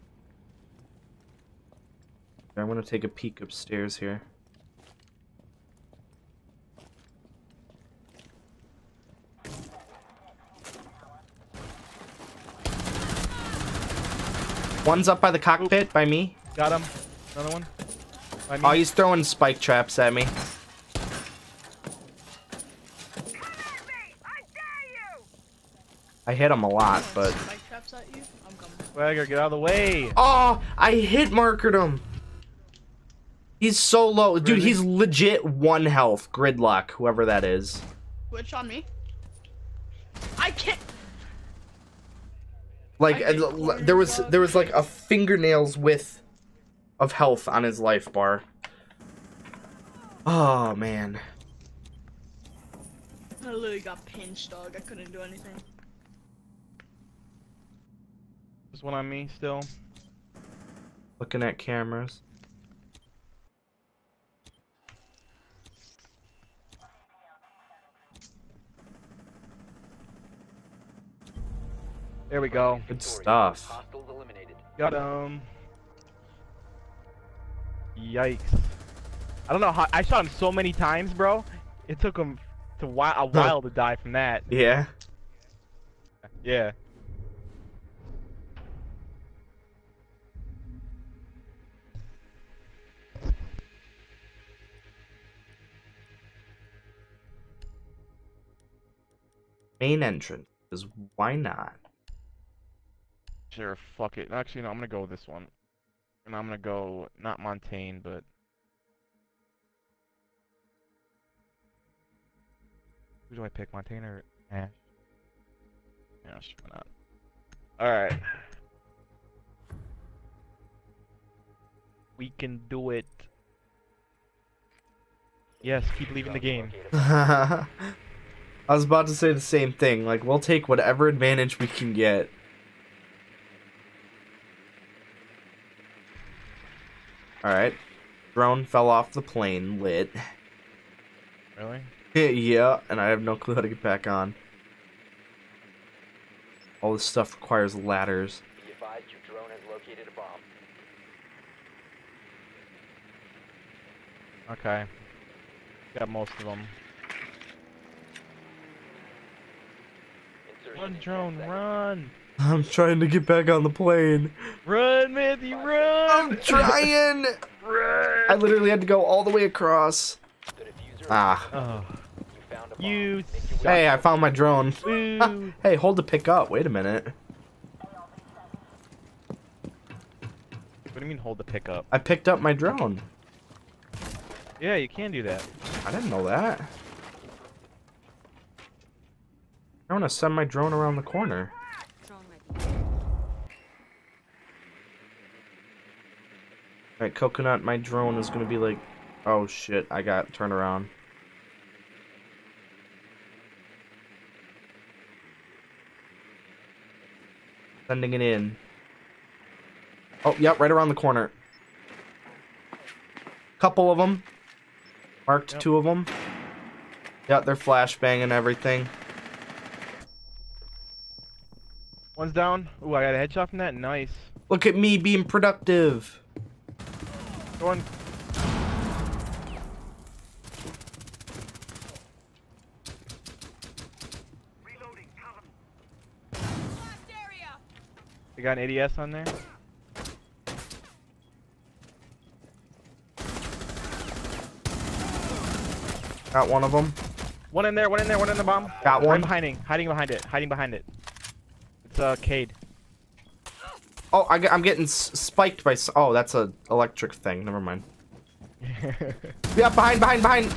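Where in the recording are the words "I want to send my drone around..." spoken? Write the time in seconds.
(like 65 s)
189 s.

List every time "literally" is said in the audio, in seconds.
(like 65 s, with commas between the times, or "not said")
53 s, 168 s.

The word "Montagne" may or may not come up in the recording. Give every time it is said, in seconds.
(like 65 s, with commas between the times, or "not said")
107 s, 113 s.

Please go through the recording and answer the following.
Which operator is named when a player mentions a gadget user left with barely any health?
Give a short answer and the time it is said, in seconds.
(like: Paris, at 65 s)
Gridlock, at 36 s.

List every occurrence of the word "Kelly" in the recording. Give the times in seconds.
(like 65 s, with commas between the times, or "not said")
not said.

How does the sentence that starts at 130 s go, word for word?
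Like, we'll take whatever advantage we can get.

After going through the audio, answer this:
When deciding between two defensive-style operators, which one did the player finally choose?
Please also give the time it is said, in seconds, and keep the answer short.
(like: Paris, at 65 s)
Ash, at 116 s.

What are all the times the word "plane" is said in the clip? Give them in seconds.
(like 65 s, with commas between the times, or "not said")
139 s, 163 s.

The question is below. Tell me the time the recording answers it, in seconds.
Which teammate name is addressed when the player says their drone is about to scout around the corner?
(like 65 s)
197 s.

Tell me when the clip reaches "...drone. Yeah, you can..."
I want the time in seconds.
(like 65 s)
182 s.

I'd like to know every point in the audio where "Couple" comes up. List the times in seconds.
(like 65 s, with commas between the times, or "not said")
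213 s.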